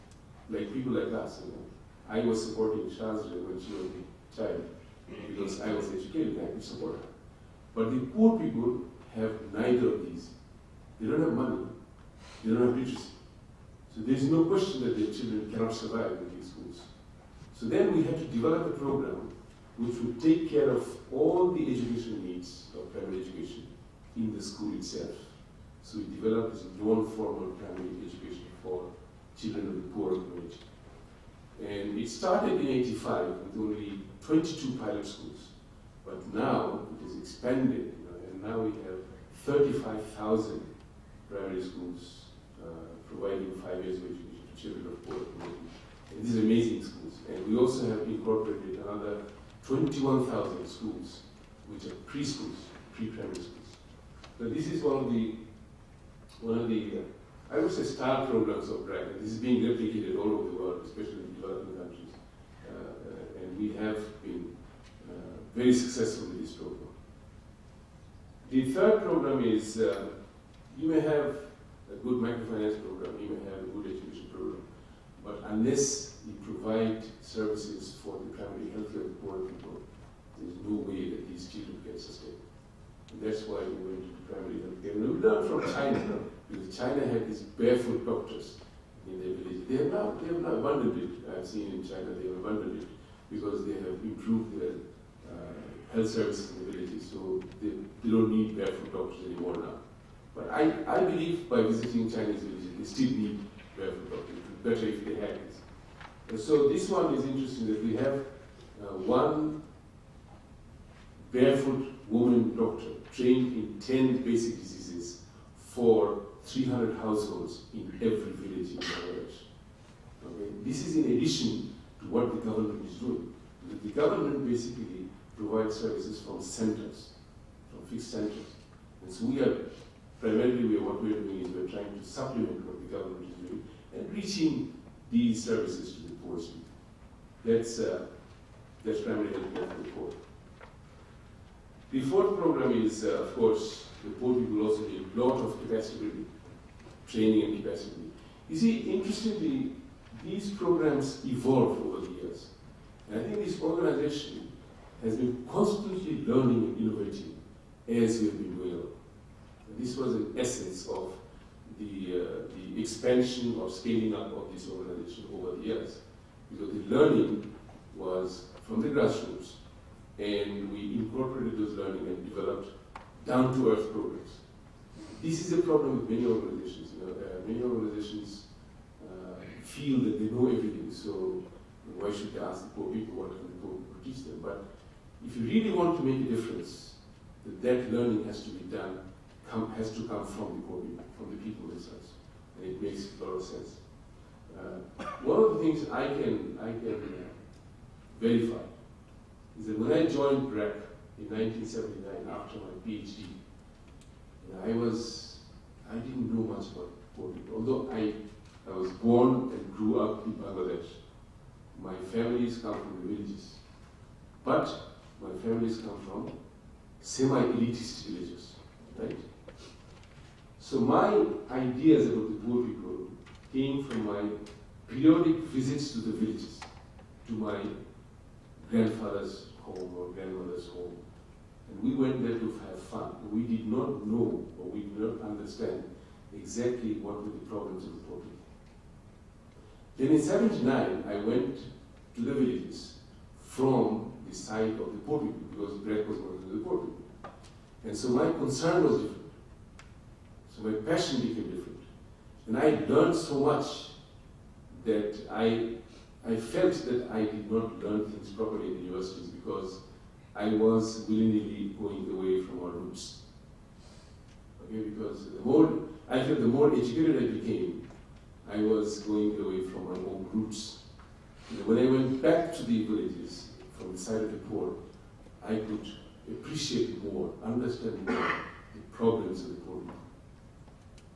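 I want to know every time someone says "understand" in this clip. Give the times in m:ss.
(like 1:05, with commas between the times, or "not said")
3:55, 4:37.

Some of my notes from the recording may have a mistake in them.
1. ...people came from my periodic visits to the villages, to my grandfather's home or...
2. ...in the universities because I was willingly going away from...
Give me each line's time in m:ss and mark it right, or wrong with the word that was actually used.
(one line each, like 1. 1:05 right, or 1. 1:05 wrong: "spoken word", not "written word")
1. 3:42 right
2. 4:18 right.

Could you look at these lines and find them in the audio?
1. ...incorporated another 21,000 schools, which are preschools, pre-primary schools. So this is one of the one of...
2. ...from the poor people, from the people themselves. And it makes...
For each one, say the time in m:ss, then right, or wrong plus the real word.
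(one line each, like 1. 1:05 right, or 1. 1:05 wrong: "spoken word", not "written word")
1. 0:48 right
2. 3:10 right.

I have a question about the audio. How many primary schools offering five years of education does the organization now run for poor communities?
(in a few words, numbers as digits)
35,000.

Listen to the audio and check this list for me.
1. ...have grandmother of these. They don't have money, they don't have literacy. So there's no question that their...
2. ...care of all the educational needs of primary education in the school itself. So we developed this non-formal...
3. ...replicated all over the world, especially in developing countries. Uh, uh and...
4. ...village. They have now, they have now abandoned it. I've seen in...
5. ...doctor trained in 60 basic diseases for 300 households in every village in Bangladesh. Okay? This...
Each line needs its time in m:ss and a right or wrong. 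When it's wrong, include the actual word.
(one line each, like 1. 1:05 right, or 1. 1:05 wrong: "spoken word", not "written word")
1. 0:09 wrong: "neither", not "grandmother"
2. 0:20 right
3. 0:59 right
4. 1:29 right
5. 1:52 wrong: "10", not "60".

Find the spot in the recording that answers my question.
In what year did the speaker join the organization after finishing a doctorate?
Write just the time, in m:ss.
3:21.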